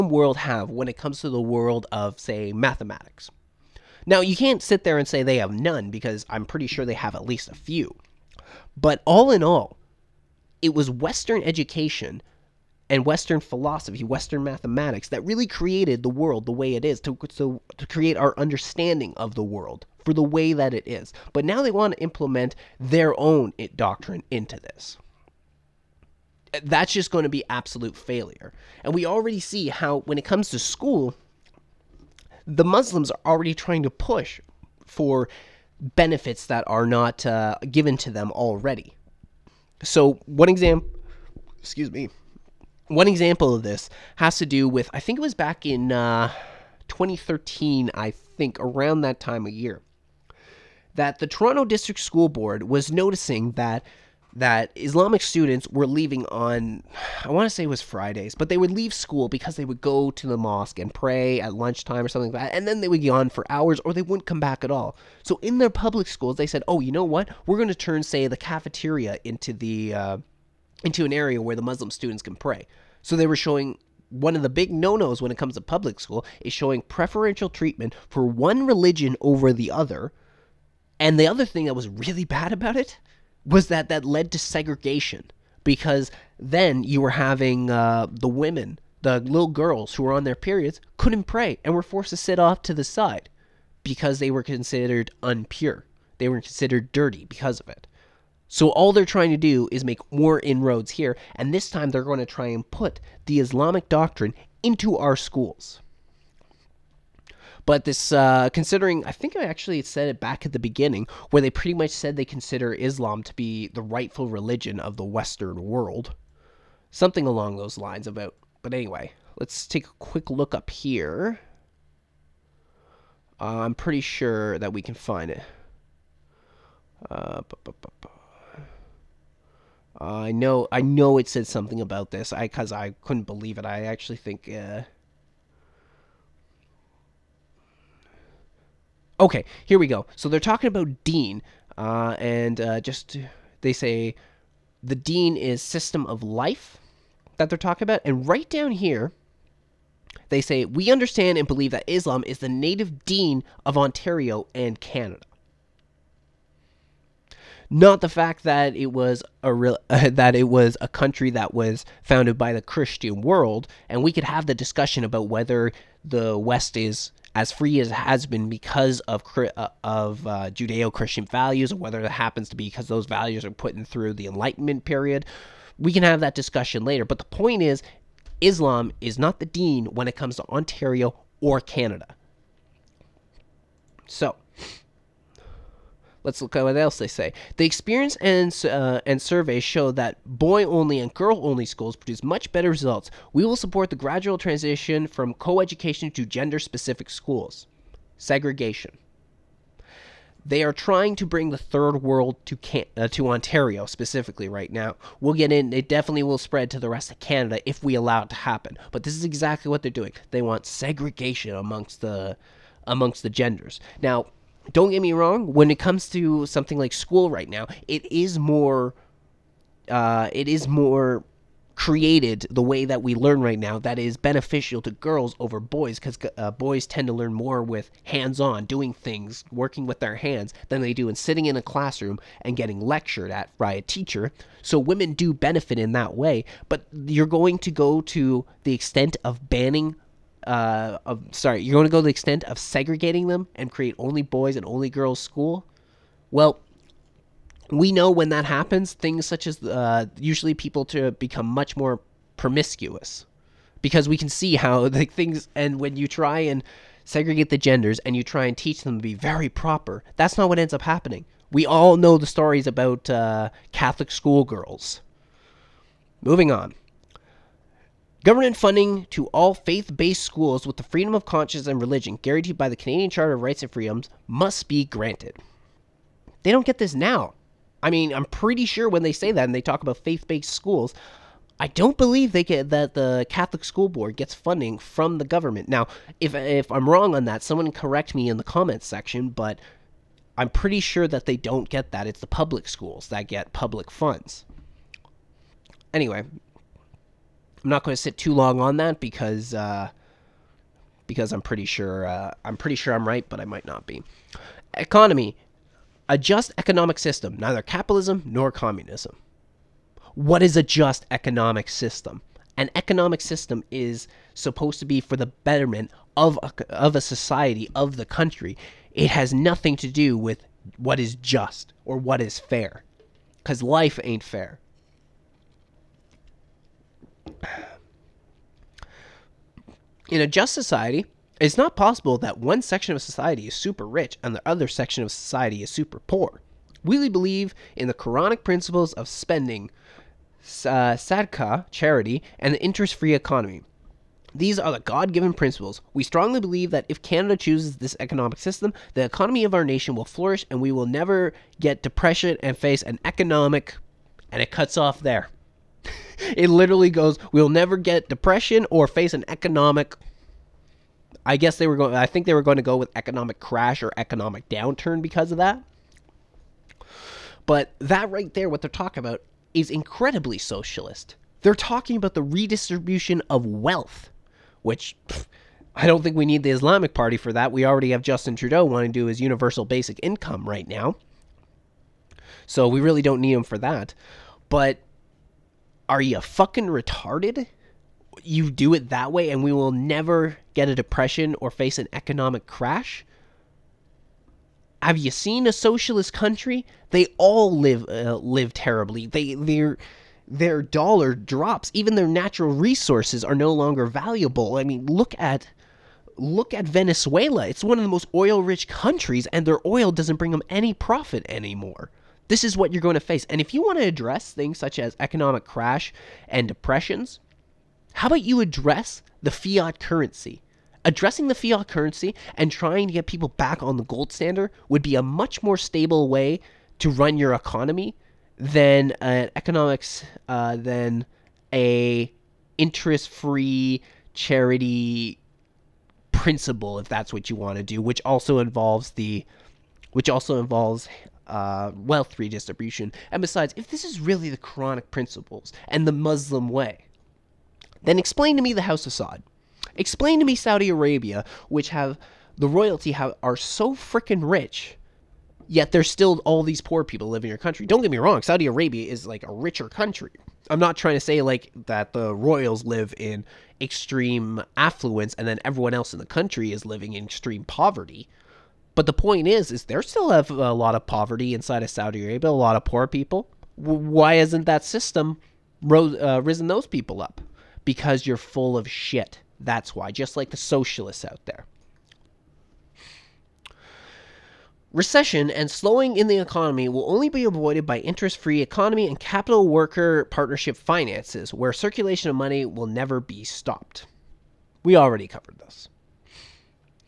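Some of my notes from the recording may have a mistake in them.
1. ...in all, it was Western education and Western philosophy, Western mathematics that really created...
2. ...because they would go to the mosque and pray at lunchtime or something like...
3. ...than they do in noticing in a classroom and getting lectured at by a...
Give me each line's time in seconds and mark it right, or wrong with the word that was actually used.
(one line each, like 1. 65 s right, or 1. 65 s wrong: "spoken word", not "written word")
1. 9 s right
2. 59 s right
3. 230 s wrong: "sitting", not "noticing".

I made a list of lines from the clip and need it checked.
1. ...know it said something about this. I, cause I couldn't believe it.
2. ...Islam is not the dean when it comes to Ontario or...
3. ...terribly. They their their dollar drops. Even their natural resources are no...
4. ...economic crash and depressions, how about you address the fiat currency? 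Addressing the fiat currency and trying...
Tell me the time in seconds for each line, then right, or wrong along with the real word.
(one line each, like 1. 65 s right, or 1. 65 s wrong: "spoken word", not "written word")
1. 130 s right
2. 178 s right
3. 398 s right
4. 414 s right.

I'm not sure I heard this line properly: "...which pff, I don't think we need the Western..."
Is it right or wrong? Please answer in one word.
wrong.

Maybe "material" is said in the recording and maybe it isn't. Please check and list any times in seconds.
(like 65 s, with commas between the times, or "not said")
not said.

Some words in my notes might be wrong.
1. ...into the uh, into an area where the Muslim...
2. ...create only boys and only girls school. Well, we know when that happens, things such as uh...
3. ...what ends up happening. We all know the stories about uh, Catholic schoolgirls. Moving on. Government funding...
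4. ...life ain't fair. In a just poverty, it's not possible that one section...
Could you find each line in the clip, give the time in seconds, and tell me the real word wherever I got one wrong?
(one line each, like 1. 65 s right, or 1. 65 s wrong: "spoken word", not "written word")
1. 69 s right
2. 243 s right
3. 260 s right
4. 323 s wrong: "society", not "poverty".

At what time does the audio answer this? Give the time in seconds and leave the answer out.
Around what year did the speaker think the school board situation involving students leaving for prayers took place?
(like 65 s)
46 s.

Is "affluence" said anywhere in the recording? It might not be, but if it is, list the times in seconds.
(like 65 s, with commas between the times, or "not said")
464 s.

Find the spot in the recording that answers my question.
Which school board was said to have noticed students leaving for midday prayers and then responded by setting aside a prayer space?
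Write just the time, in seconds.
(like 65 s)
51 s.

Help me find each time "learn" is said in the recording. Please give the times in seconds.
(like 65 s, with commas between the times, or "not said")
223 s, 227 s.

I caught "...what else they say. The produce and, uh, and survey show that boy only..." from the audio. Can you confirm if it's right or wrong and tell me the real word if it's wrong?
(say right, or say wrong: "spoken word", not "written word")
wrong: "experience", not "produce".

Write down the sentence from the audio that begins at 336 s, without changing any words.
We believe in the Quranic principles of spending, uh, charity, and the interest free economy.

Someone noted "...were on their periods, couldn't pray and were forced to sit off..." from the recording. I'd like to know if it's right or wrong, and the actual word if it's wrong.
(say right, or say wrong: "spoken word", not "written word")
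right.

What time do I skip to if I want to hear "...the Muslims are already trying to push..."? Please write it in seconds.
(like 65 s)
32 s.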